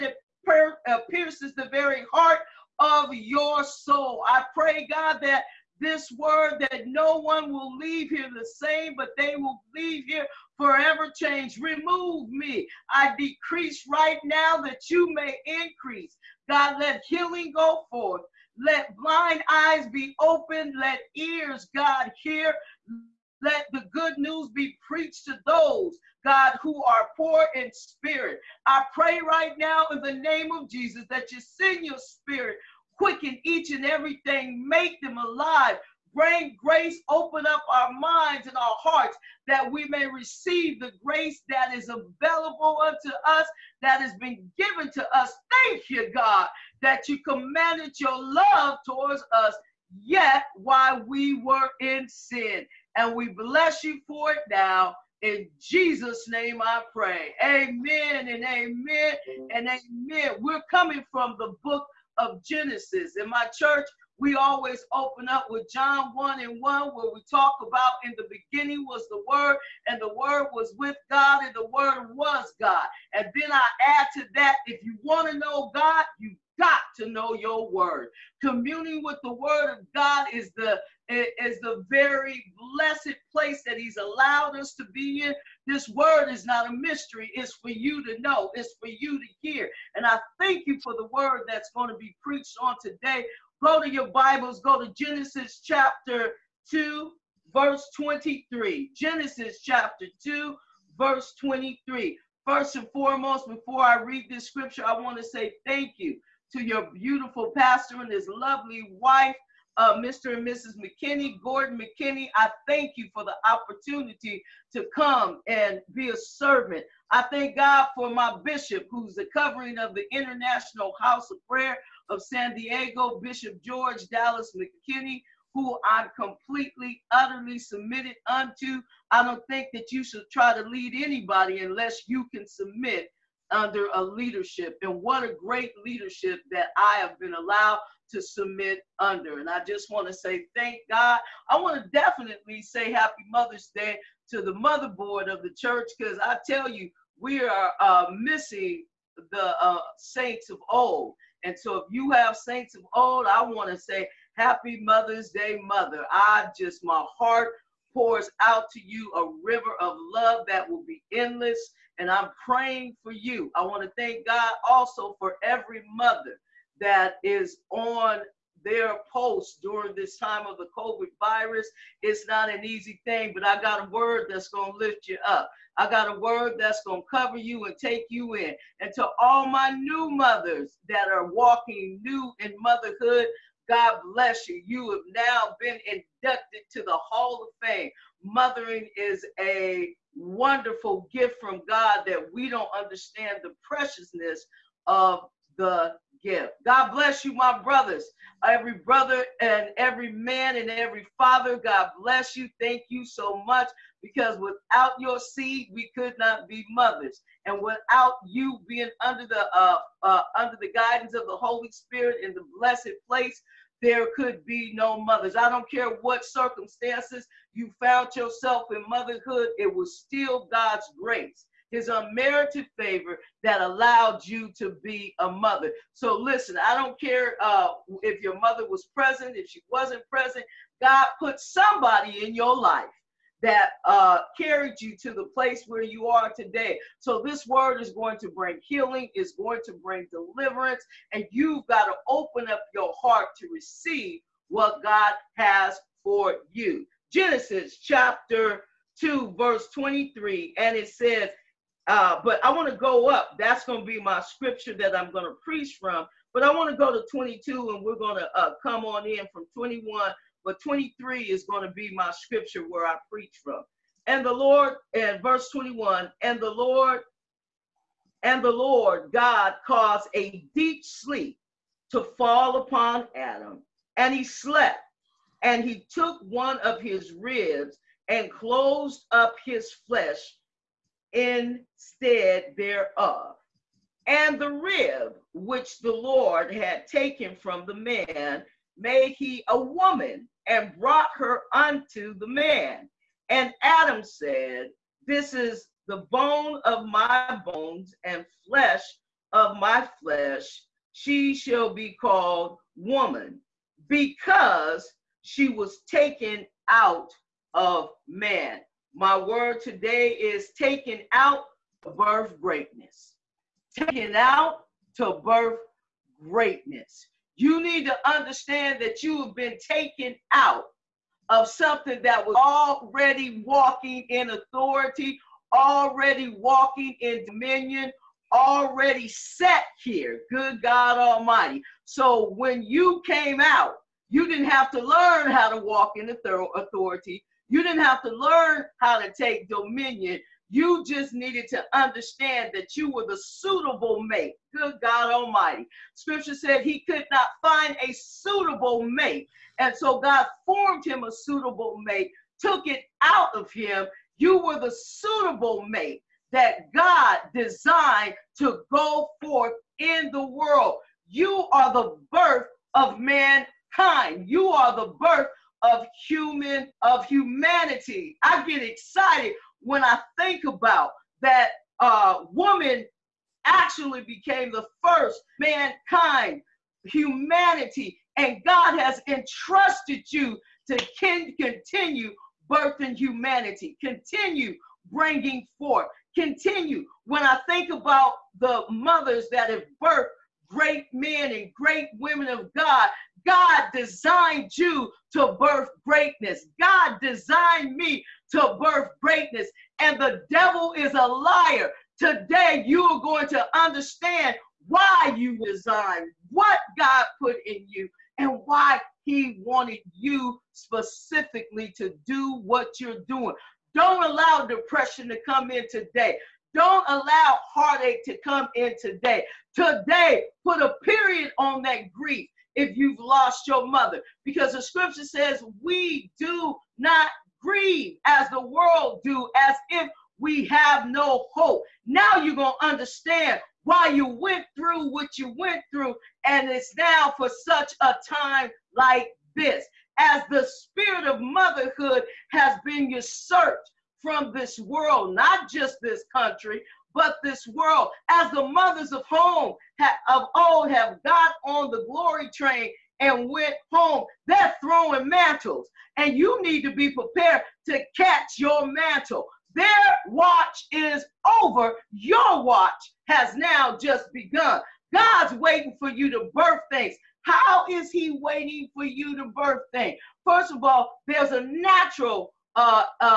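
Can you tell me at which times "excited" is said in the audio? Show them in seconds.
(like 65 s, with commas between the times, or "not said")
368 s.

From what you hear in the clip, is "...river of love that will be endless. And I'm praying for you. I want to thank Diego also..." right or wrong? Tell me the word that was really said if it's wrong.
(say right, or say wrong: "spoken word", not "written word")
wrong: "God", not "Diego".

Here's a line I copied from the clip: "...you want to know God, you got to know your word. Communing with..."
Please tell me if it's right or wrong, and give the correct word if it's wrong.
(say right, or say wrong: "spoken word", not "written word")
right.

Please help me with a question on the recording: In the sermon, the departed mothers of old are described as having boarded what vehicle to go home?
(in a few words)
The glory train.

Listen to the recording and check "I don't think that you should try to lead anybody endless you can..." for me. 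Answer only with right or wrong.
wrong.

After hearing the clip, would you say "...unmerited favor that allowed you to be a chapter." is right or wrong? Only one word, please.
wrong.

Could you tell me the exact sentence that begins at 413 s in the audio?
Don't allow depression to come in today.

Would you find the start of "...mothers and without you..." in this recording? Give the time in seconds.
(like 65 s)
206 s.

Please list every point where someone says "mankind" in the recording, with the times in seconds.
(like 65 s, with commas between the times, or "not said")
362 s, 375 s.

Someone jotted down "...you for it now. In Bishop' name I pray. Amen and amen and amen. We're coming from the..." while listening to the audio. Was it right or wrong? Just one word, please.
wrong.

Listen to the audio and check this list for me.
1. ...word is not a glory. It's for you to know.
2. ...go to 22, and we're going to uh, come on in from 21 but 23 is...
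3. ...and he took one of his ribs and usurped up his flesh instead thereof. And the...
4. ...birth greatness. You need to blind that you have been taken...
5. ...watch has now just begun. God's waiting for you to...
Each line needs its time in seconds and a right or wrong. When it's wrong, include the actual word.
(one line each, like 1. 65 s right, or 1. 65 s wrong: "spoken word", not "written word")
1. 85 s wrong: "mystery", not "glory"
2. 256 s right
3. 275 s wrong: "closed", not "usurped"
4. 315 s wrong: "understand", not "blind"
5. 462 s right.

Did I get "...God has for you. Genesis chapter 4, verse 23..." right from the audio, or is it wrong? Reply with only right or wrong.
wrong.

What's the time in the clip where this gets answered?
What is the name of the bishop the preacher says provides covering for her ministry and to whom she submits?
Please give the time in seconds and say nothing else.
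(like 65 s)
123 s.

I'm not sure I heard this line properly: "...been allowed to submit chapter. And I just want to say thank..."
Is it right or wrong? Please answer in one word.
wrong.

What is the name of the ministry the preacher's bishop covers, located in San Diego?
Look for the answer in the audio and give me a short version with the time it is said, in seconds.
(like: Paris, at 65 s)
International House of Prayer, at 120 s.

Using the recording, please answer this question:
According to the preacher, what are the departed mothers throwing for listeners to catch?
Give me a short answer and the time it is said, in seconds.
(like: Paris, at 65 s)
Mantles, at 455 s.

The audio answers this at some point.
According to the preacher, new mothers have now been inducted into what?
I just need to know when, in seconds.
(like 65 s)
187 s.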